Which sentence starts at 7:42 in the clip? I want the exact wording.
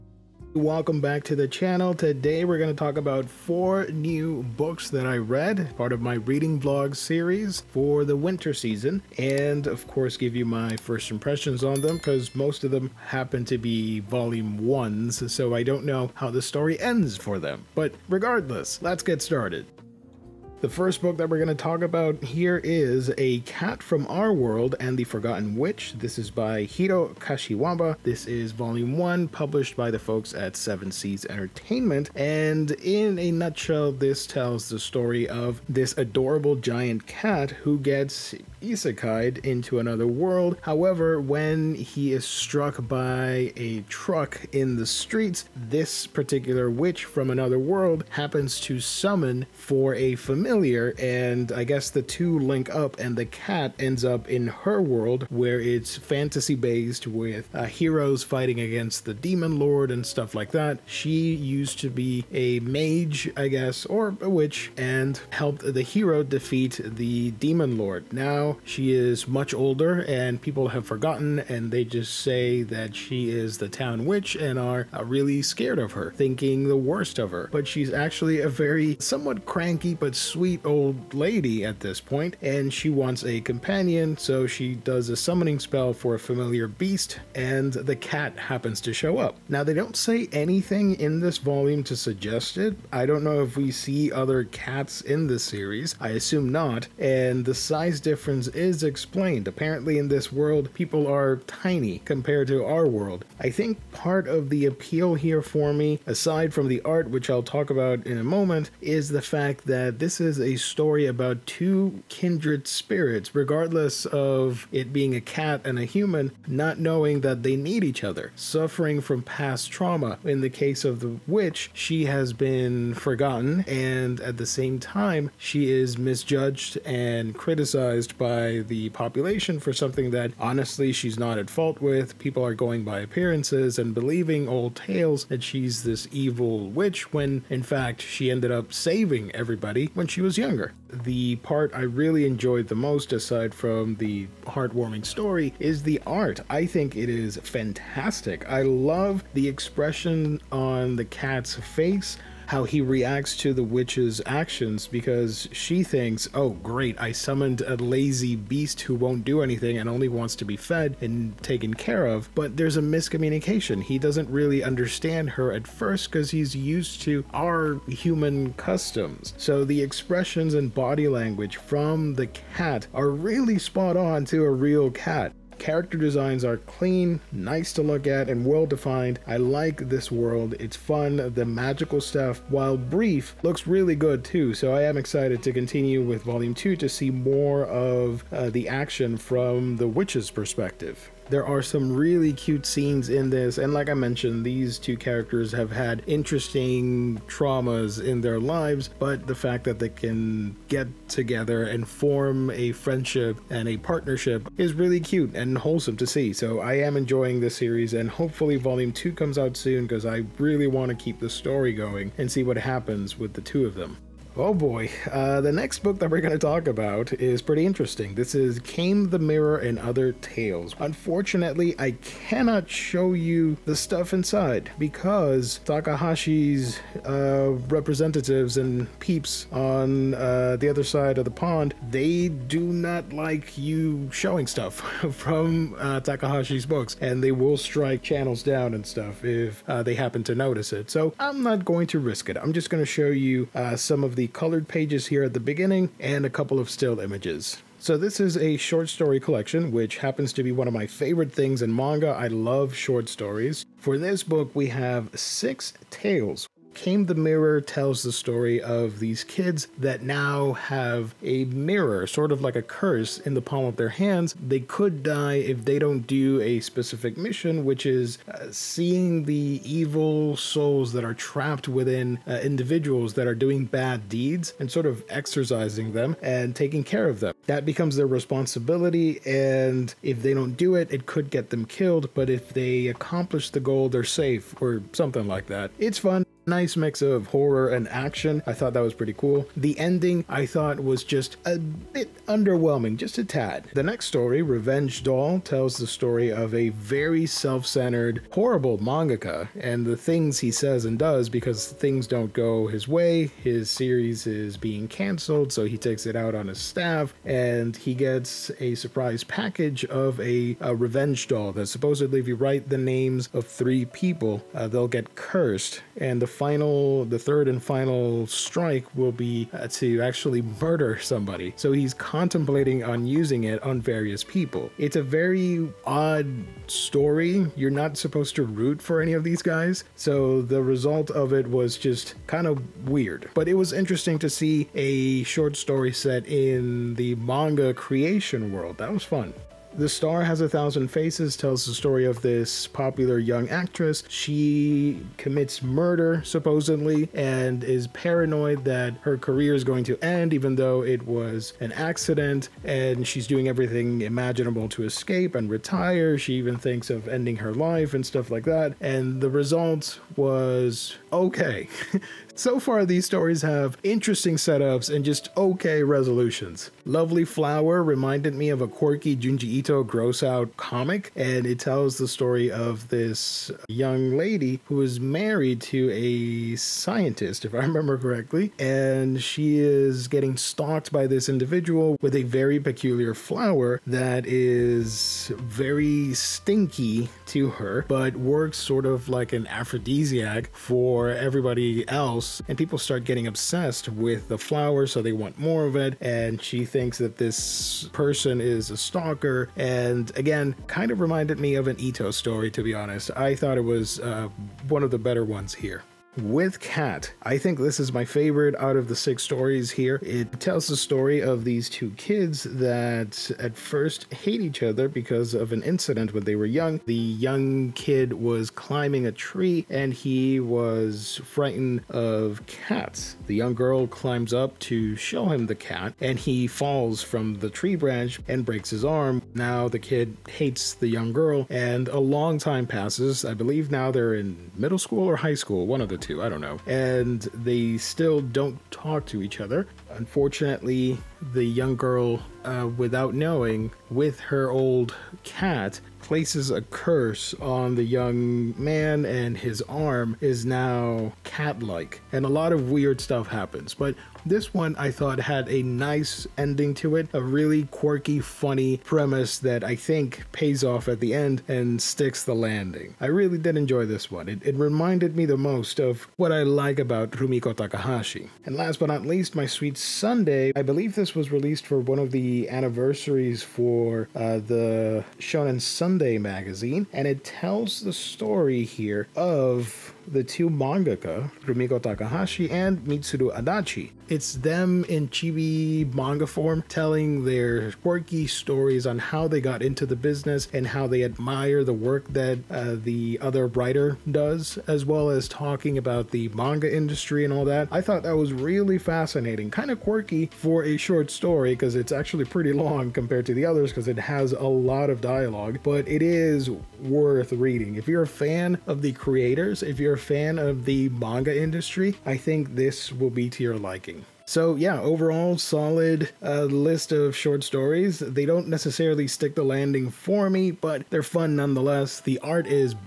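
I really did enjoy this one.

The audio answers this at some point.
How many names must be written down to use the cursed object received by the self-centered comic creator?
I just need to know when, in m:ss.
5:13.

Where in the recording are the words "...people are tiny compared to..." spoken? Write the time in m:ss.
1:40.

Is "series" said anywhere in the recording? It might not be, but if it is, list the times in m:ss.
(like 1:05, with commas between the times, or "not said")
0:06, 1:35, 3:27, 5:03.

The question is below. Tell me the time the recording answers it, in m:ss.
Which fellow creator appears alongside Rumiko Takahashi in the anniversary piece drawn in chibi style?
8:02.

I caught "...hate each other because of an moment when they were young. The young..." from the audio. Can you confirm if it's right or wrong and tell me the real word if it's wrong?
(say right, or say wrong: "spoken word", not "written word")
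wrong: "incident", not "moment".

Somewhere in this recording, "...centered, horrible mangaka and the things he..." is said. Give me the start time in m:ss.
4:57.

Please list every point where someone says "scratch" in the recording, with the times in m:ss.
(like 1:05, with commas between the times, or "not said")
not said.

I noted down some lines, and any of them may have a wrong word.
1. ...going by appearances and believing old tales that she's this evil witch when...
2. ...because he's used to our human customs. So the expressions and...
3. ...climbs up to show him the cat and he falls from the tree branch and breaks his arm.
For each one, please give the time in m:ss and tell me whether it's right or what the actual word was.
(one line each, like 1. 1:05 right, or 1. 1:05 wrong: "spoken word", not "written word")
1. 2:12 right
2. 2:46 right
3. 7:03 right.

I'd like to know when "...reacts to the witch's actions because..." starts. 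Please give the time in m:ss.
2:32.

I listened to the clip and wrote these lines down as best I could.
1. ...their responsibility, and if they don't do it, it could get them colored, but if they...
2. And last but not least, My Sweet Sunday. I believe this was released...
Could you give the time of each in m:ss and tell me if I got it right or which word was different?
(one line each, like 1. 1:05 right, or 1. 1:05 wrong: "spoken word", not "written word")
1. 4:37 wrong: "killed", not "colored"
2. 7:48 right.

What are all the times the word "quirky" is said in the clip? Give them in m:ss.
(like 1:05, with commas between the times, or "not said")
6:08, 7:37, 8:07, 8:19.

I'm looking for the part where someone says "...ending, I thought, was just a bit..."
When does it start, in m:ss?
4:49.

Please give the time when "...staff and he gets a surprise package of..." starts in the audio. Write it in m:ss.
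5:06.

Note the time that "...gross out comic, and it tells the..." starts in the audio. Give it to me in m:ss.
6:09.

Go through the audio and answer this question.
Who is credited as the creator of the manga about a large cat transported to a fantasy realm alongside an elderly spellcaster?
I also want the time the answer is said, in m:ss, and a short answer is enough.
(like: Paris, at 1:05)
Hiro Kashiwaba, at 0:26.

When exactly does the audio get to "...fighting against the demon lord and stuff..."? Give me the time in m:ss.
0:58.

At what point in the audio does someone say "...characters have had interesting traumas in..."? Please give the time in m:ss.
3:14.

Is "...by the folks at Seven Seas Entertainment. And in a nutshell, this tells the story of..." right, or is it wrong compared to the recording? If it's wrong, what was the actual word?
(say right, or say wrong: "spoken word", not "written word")
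right.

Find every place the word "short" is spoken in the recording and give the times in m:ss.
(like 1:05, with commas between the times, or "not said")
4:08, 4:12, 5:35, 8:20, 8:37.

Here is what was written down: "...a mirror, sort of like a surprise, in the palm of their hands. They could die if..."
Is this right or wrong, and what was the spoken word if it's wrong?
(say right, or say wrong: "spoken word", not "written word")
wrong: "curse", not "surprise".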